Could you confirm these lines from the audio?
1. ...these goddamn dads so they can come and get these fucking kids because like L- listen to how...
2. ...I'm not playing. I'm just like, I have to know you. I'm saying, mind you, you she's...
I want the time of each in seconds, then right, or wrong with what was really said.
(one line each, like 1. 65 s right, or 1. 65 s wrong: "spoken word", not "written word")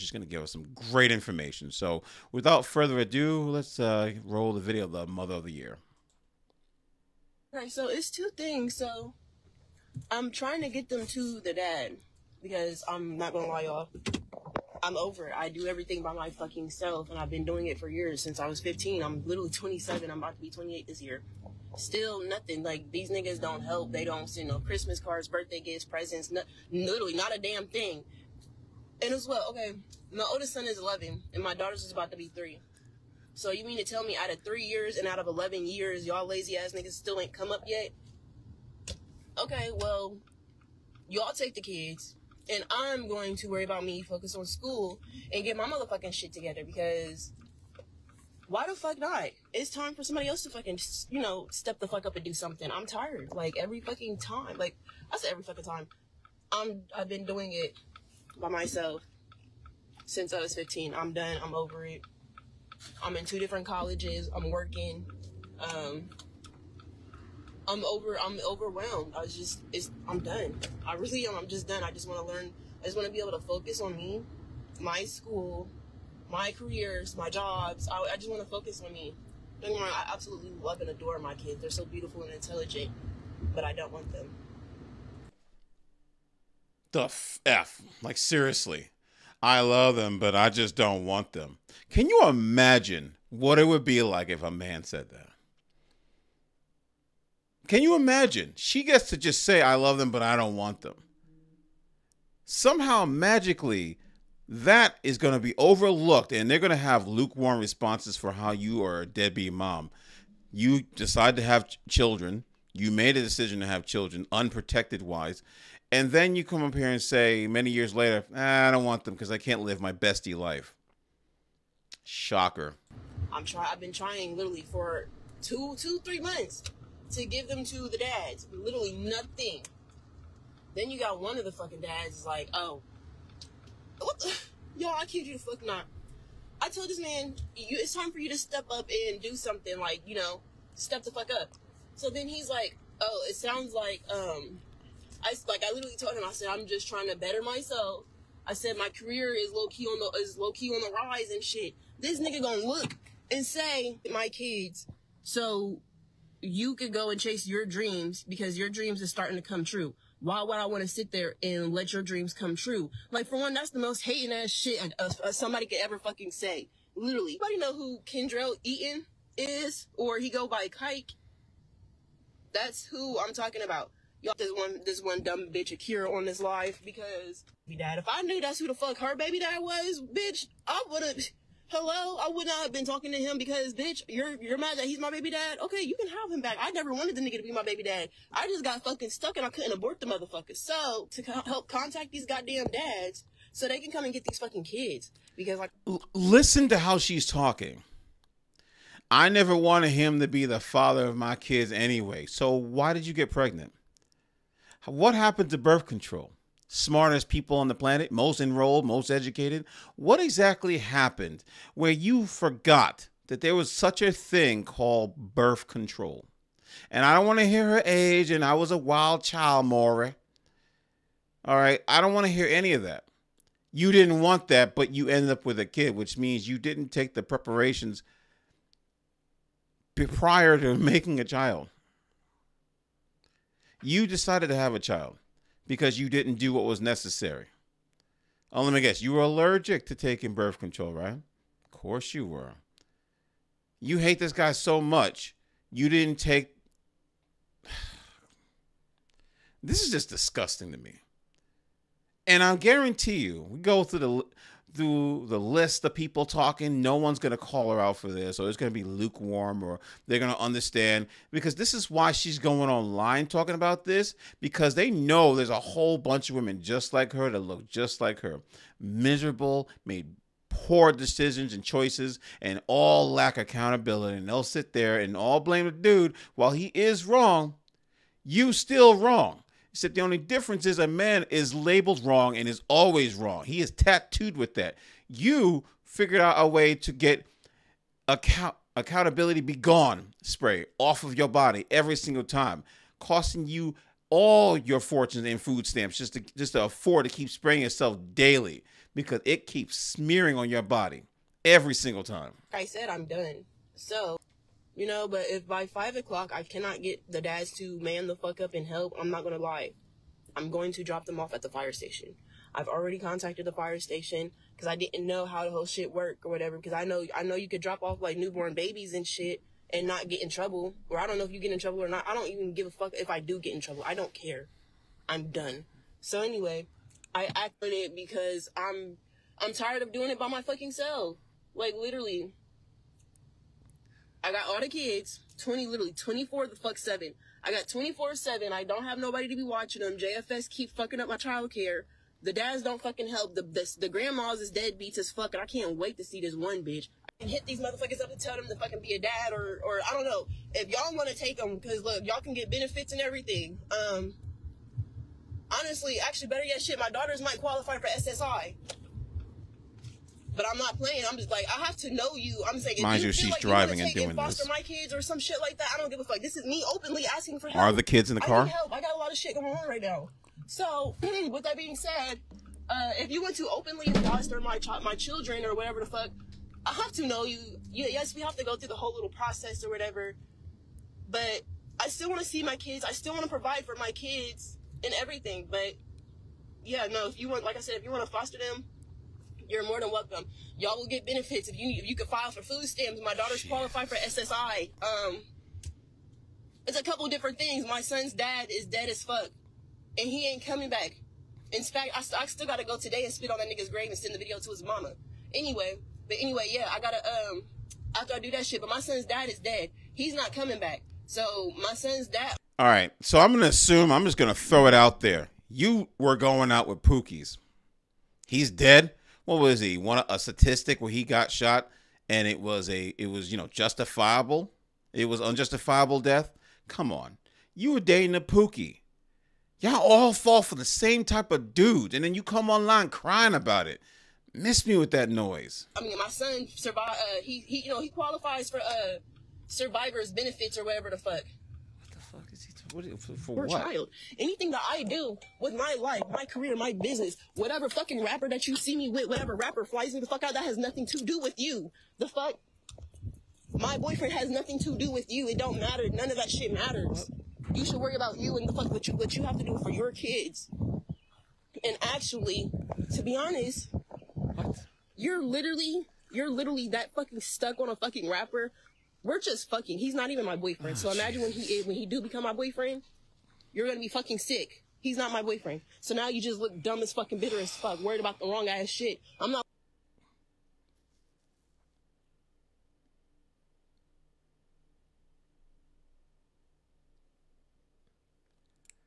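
1. 192 s right
2. 360 s right.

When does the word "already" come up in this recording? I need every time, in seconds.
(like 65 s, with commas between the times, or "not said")
312 s.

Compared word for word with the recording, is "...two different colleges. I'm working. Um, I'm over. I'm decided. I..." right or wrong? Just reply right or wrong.
wrong.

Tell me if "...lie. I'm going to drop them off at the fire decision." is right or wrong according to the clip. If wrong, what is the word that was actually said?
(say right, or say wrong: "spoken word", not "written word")
wrong: "station", not "decision".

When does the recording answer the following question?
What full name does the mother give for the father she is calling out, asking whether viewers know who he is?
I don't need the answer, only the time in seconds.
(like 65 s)
168 s.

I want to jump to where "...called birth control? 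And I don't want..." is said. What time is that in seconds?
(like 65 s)
214 s.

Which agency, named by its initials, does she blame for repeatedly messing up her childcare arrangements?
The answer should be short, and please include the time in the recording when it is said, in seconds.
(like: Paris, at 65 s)
JFS, at 339 s.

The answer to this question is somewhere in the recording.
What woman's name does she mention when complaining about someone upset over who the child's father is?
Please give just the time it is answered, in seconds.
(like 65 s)
175 s.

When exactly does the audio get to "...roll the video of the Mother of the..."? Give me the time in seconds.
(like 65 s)
4 s.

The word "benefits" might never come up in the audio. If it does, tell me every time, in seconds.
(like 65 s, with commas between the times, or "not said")
352 s, 391 s, 440 s.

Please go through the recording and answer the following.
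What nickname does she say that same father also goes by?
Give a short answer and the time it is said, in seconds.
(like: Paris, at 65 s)
Kike, at 170 s.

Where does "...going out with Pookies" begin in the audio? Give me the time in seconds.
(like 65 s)
416 s.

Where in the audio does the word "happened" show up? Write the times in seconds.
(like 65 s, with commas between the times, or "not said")
205 s, 210 s.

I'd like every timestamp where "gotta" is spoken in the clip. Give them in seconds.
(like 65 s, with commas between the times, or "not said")
402 s, 406 s.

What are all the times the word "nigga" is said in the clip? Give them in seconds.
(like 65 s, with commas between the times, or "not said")
23 s, 36 s, 152 s, 187 s, 403 s.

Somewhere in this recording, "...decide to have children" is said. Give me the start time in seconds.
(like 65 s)
110 s.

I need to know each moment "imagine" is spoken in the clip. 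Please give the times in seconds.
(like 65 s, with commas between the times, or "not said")
92 s, 97 s, 470 s.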